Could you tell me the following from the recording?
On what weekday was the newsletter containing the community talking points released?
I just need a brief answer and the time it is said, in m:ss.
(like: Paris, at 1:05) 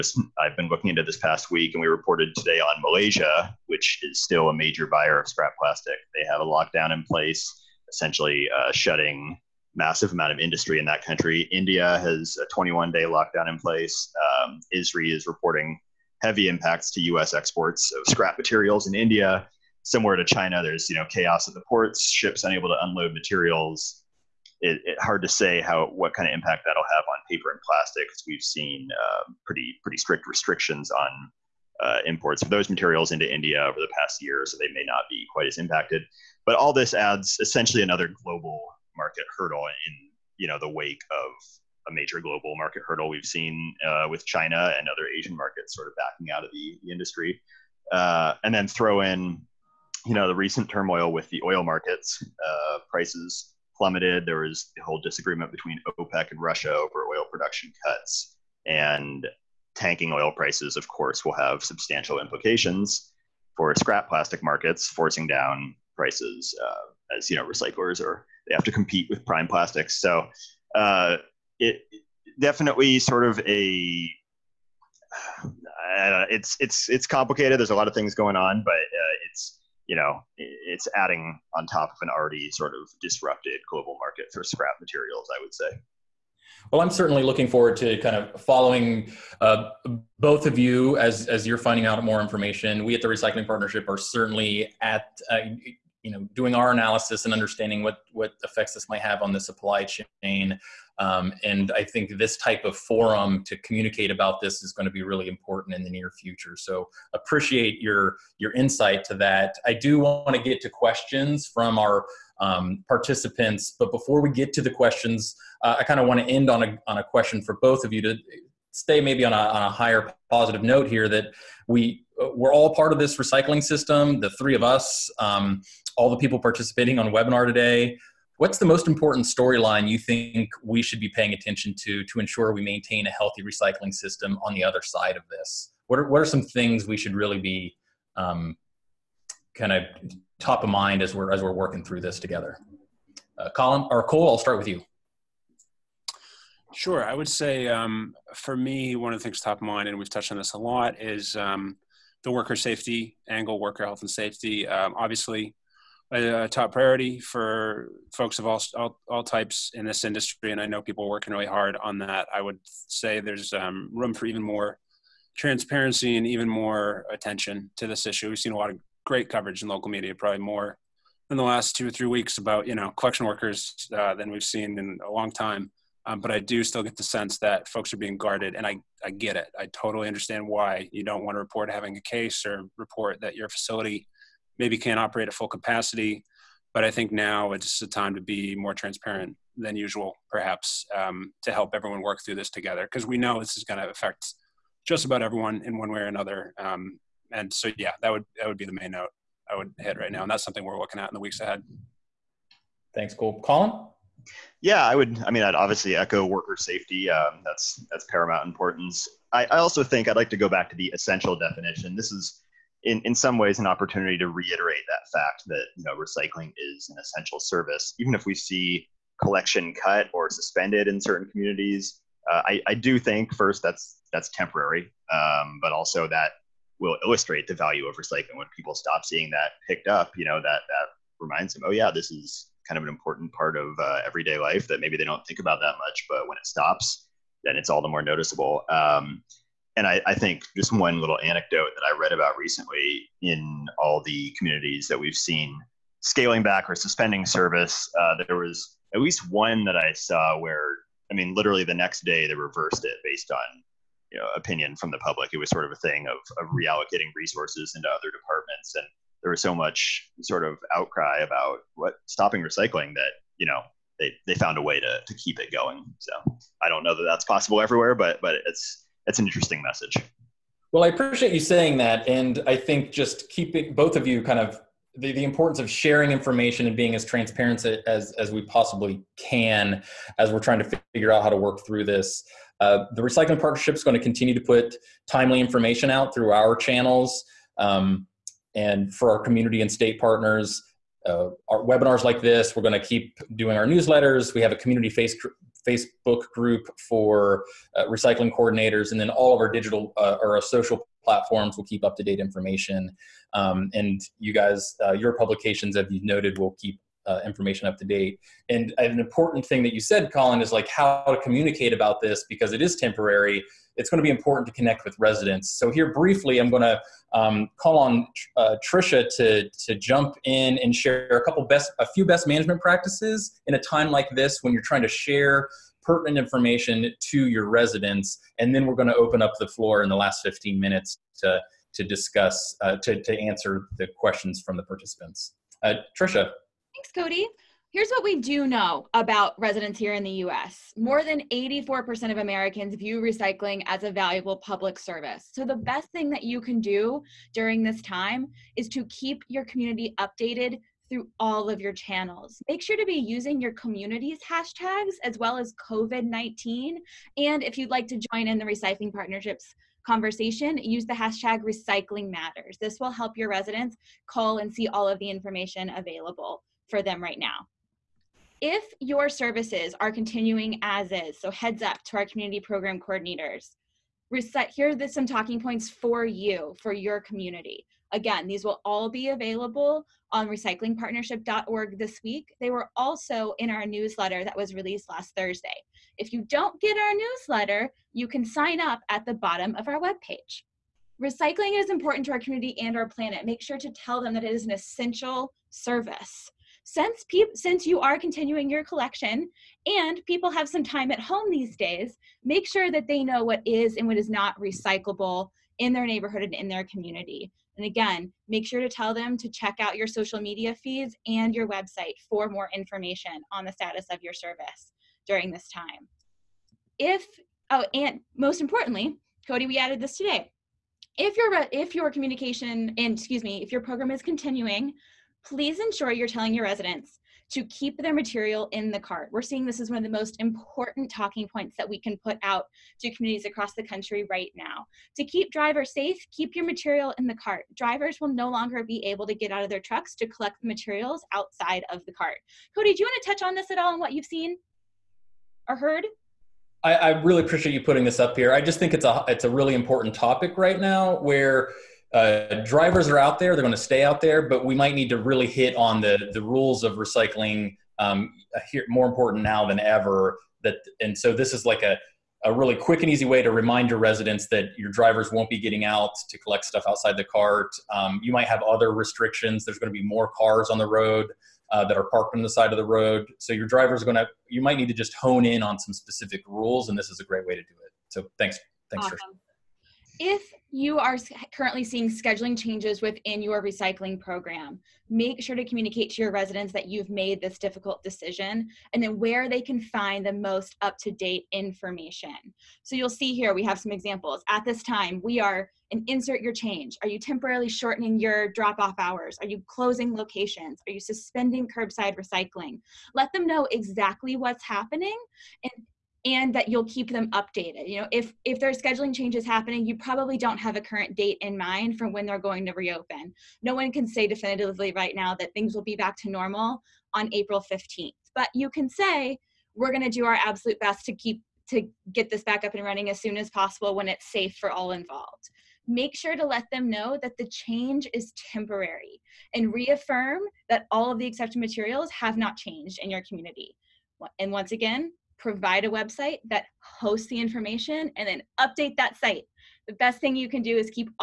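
Thursday, at 6:25.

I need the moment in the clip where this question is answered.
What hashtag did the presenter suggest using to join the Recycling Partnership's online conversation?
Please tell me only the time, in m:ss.
6:01.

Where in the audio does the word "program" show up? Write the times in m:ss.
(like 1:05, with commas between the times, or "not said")
6:12, 7:03, 8:03.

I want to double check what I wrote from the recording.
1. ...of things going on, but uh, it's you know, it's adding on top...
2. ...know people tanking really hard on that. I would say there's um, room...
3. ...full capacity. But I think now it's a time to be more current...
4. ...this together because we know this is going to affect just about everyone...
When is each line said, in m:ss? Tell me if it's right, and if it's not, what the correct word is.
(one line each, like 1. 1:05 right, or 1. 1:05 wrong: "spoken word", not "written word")
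1. 1:17 right
2. 2:40 wrong: "working", not "tanking"
3. 3:05 wrong: "transparent", not "current"
4. 3:12 right.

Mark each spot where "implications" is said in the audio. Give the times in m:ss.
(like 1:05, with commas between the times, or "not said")
1:02.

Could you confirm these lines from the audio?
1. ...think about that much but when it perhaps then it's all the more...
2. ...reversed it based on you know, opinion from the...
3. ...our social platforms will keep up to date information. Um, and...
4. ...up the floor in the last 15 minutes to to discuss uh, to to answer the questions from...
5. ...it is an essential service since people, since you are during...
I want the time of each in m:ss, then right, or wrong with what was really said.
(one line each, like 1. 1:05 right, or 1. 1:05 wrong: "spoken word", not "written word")
1. 3:55 wrong: "stops", not "perhaps"
2. 4:12 right
3. 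5:00 right
4. 5:29 right
5. 6:34 wrong: "continuing", not "during".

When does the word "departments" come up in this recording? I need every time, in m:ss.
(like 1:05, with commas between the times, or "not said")
4:18.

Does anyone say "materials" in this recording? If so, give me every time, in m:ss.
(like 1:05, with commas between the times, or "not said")
0:18, 0:23, 0:32, 1:24, 7:07, 7:16, 7:20, 8:51.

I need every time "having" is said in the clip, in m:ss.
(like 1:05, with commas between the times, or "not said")
3:01.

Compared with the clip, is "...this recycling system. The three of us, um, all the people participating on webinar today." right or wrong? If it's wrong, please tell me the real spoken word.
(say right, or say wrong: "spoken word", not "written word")
right.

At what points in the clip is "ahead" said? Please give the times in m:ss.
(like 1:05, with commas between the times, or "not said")
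3:21.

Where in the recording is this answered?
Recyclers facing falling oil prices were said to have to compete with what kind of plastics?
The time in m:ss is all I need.
1:09.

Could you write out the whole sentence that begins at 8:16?
Are you temporarily shortening your drop off hours?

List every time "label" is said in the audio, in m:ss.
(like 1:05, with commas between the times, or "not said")
not said.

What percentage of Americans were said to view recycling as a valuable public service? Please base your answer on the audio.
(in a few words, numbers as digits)
84%.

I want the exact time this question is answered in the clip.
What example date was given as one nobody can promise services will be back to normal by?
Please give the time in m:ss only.
8:37.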